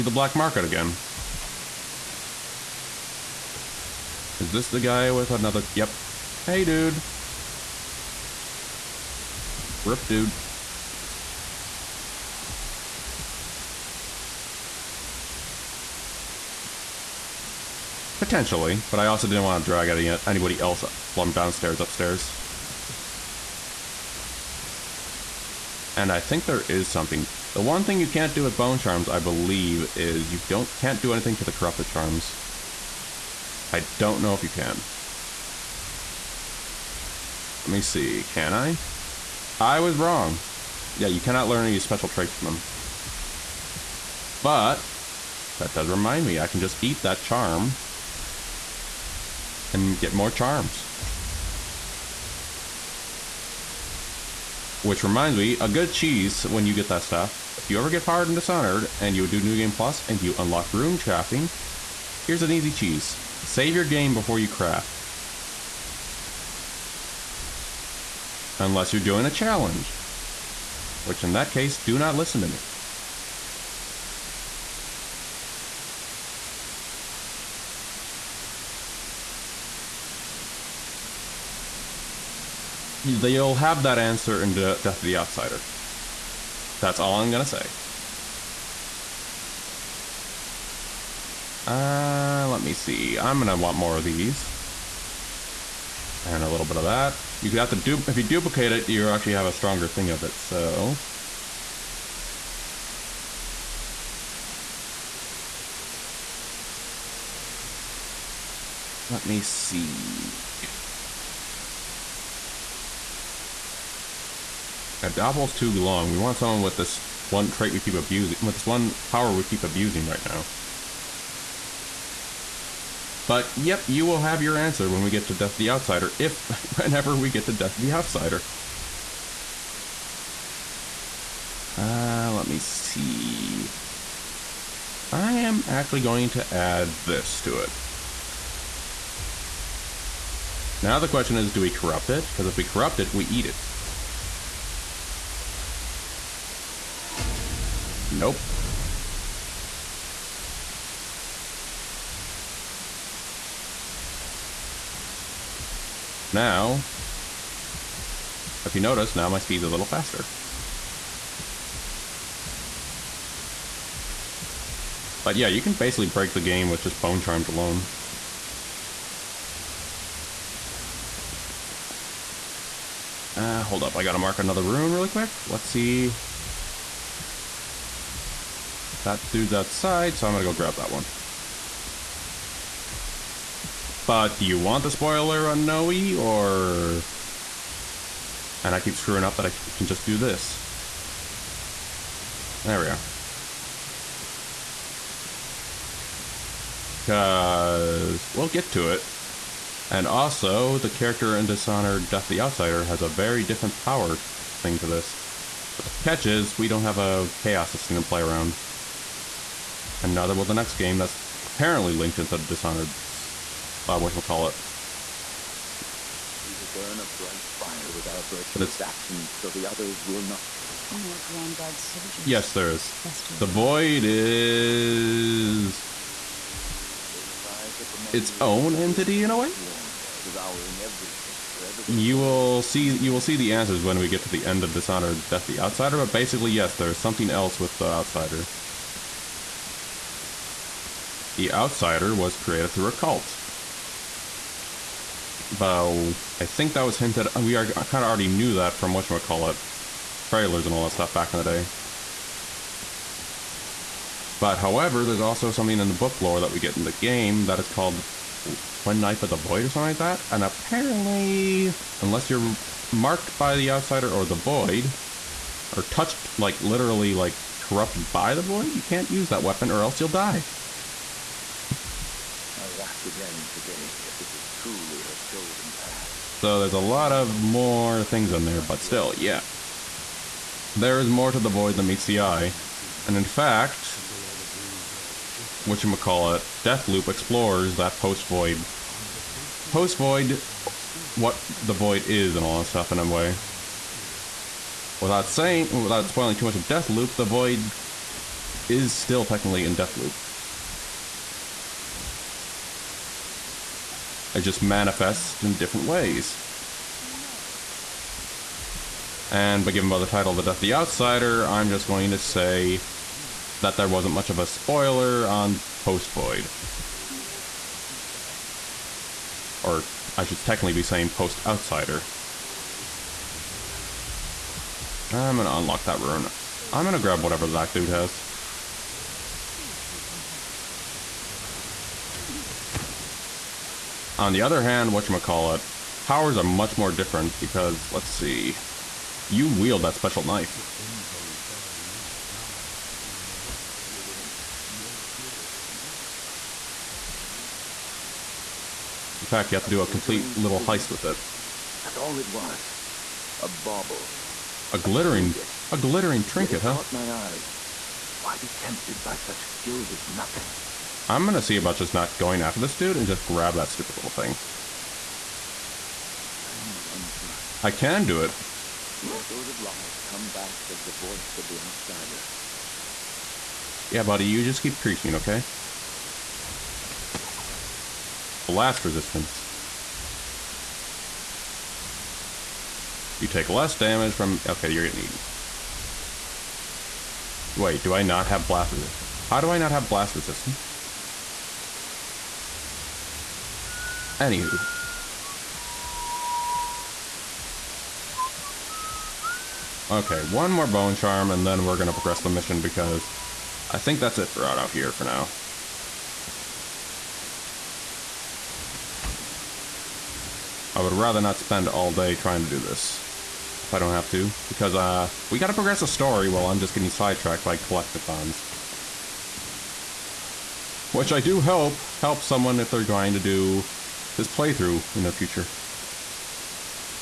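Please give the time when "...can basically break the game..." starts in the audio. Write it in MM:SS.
02:45.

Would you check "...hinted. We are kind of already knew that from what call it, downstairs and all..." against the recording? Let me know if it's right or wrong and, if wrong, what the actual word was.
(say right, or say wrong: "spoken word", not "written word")
wrong: "trailers", not "downstairs".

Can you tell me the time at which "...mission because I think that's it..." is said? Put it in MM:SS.
06:42.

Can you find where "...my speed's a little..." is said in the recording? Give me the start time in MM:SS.
02:39.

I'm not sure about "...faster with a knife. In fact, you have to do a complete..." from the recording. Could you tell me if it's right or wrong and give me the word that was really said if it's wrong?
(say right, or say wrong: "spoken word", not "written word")
wrong: "gooder", not "faster".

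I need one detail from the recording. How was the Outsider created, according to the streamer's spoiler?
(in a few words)
through a cult.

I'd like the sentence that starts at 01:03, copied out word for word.
Save your game before you craft.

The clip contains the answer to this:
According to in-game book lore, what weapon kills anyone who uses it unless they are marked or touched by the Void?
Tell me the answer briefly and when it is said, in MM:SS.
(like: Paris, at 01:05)
Twin Knife of the Void, at 04:18.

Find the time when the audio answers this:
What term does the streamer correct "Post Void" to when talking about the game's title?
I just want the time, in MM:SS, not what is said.
05:21.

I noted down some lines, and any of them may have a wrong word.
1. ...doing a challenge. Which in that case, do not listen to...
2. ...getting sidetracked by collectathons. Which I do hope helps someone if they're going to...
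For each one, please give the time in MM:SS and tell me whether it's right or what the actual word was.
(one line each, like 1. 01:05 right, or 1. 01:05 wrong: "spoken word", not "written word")
1. 01:09 right
2. 06:56 right.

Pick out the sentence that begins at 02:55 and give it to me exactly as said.
Let's see that dude's outside, so I'm gonna go grab that one.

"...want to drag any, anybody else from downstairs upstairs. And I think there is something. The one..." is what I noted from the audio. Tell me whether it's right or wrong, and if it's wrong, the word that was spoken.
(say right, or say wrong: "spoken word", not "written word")
right.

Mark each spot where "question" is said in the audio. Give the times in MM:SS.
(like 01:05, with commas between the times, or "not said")
02:21.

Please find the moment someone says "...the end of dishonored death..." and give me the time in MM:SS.
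03:54.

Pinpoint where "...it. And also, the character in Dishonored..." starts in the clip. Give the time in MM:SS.
03:18.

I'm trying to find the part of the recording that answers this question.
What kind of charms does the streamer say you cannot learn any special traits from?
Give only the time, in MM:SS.
00:31.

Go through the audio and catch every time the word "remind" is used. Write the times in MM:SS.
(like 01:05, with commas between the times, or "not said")
00:45, 00:55.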